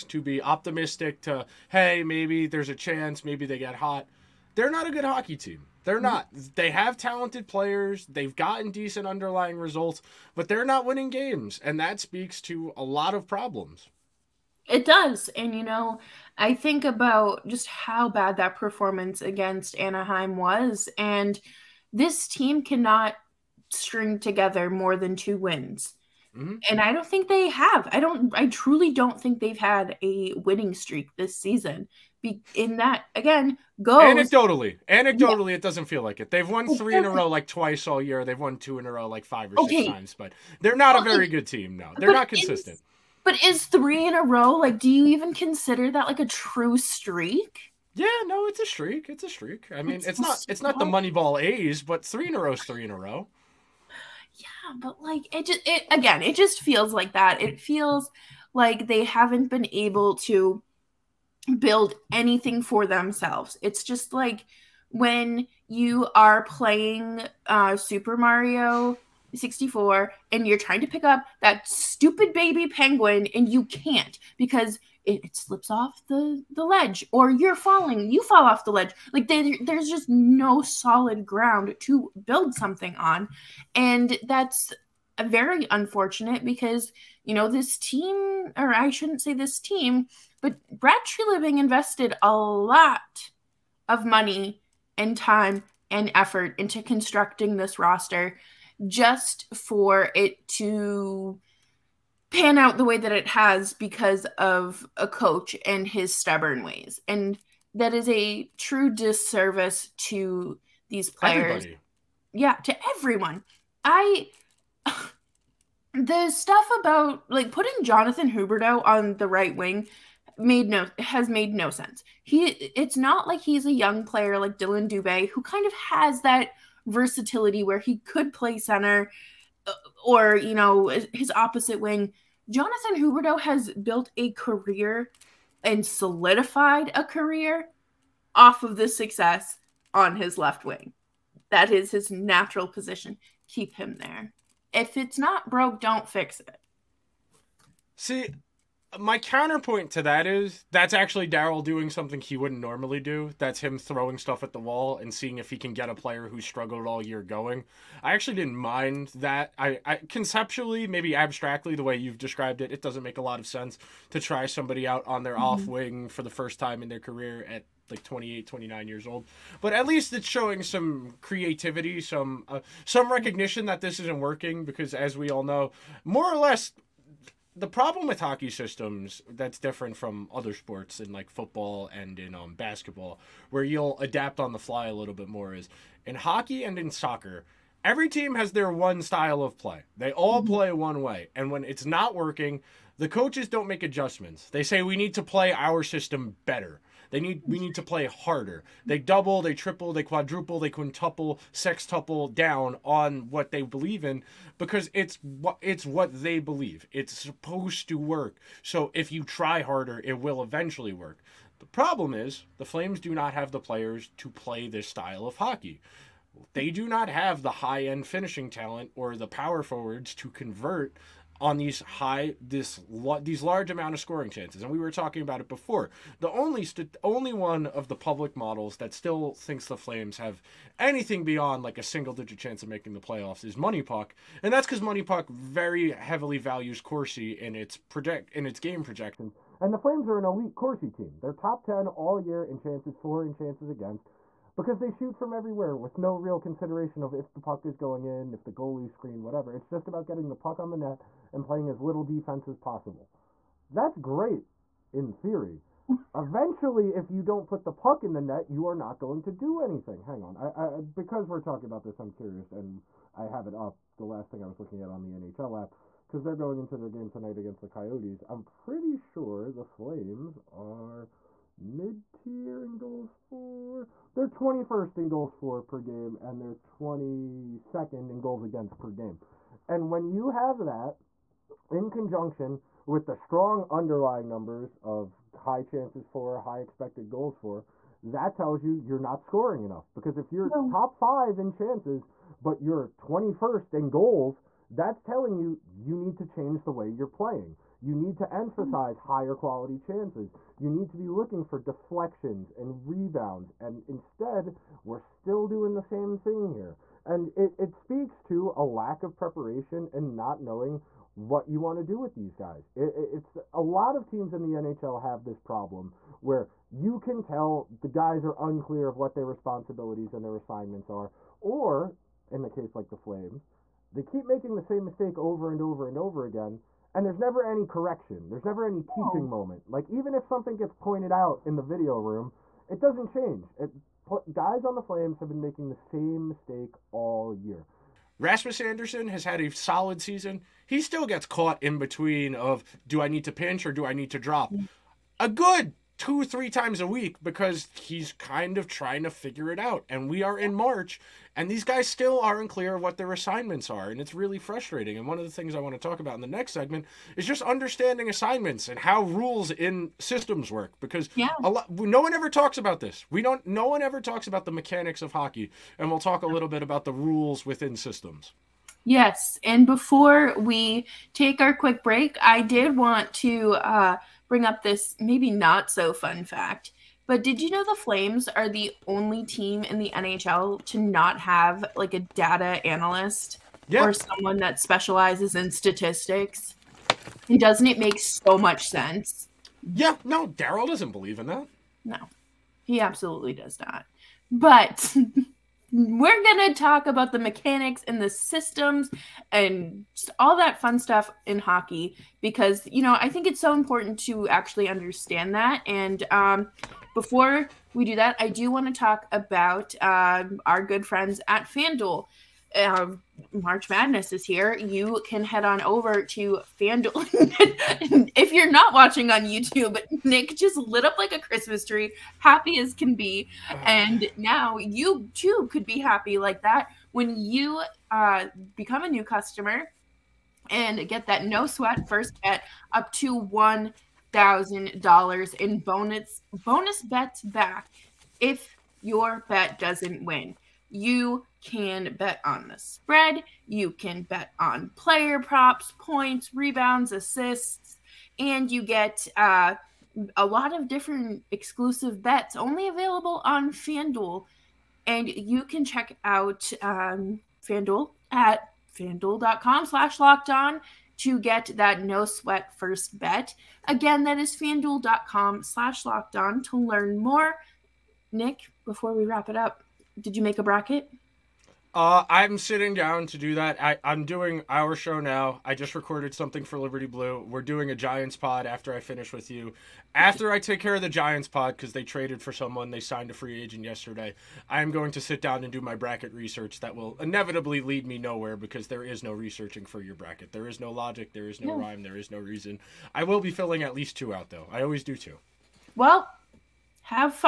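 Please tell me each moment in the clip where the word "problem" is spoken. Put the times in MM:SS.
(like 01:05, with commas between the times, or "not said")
00:13, 02:57, 03:31, 05:15.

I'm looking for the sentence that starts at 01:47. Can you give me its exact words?
And that is a true disservice to these players.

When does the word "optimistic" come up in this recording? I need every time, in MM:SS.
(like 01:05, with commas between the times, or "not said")
00:00.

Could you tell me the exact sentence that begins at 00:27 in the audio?
I don't I truly don't think they've had a winning streak this season.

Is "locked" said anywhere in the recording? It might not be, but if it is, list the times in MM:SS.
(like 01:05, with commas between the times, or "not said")
07:40, 07:45.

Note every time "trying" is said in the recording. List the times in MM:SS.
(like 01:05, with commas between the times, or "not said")
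01:10, 05:48.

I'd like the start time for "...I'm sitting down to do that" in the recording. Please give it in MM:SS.
07:52.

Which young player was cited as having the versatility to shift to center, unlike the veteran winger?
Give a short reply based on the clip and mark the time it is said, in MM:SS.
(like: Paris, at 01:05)
Dillon Dubé, at 02:04.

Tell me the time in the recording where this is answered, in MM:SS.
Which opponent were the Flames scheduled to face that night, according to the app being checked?
04:27.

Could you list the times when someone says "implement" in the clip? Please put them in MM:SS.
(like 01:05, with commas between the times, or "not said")
not said.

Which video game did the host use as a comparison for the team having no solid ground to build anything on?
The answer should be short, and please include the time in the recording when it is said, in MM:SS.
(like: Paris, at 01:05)
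Super Mario 64, at 01:07.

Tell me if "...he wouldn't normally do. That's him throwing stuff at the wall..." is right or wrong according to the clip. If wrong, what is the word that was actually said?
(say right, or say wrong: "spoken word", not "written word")
right.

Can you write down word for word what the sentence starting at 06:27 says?
And doesn't it make so much sense?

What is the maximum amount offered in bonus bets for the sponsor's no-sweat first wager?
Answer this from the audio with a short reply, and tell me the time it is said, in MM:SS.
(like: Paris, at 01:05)
$1,000, at 07:13.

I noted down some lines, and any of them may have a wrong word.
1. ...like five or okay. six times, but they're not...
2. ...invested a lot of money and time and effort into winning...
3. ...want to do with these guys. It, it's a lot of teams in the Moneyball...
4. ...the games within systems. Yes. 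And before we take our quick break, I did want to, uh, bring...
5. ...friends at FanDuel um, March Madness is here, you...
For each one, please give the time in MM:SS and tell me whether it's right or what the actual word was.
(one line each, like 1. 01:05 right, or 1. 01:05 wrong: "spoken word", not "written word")
1. 00:39 right
2. 01:31 wrong: "constructing", not "winning"
3. 05:11 wrong: "NHL", not "Moneyball"
4. 06:06 wrong: "rules", not "games"
5. 06:50 right.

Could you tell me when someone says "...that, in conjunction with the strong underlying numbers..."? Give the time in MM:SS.
04:40.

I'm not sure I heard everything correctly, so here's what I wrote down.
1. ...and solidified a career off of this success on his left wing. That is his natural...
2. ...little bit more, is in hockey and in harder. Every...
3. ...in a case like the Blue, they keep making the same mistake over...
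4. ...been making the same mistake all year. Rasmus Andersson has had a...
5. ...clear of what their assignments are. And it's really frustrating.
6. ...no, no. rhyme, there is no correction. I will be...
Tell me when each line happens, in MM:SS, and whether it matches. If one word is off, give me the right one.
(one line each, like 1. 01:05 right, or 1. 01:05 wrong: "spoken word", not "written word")
1. 02:15 right
2. 03:04 wrong: "soccer", not "harder"
3. 05:22 wrong: "Flames", not "Blue"
4. 05:35 right
5. 05:52 right
6. 08:11 wrong: "reason", not "correction".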